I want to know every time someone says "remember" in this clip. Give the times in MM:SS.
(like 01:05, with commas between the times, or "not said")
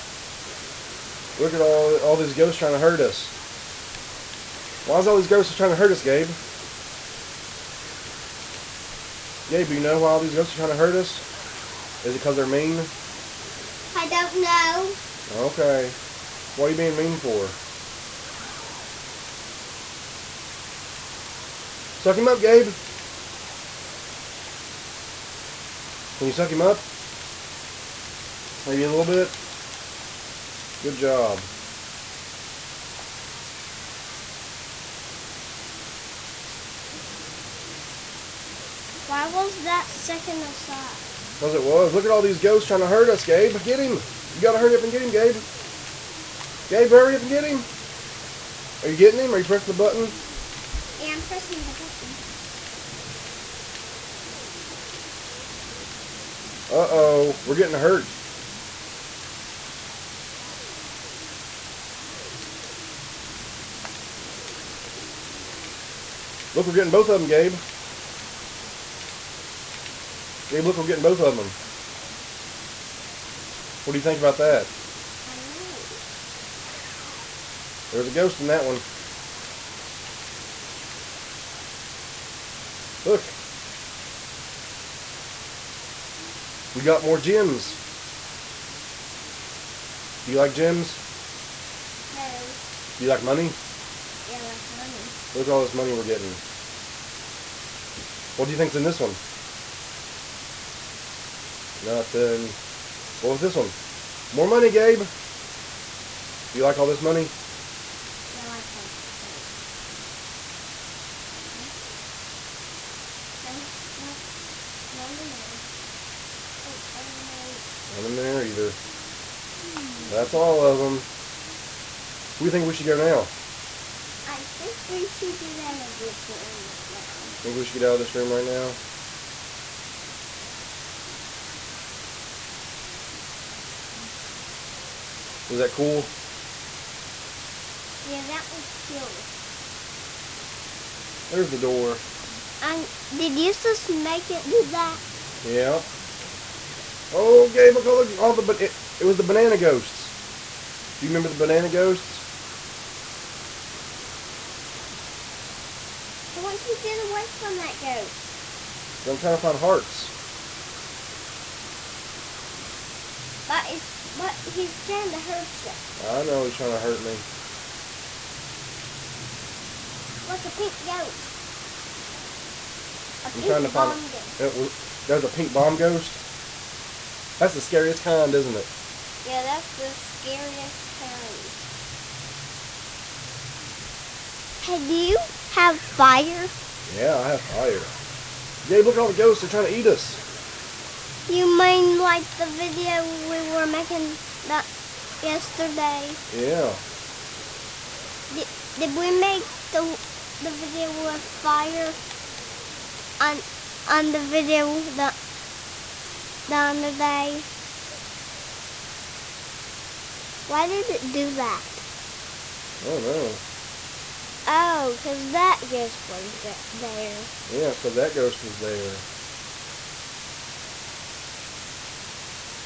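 02:31.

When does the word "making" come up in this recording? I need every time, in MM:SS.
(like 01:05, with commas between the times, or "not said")
03:13.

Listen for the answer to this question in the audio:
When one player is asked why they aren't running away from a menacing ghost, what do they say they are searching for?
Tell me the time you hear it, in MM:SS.
02:39.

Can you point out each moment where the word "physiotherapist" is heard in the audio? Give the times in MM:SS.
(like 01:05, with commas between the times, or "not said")
not said.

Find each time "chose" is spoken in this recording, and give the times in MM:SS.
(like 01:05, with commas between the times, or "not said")
not said.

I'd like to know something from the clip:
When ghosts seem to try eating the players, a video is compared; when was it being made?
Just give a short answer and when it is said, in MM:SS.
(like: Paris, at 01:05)
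yesterday, at 03:15.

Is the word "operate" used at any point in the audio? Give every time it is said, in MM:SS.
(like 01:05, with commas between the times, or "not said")
not said.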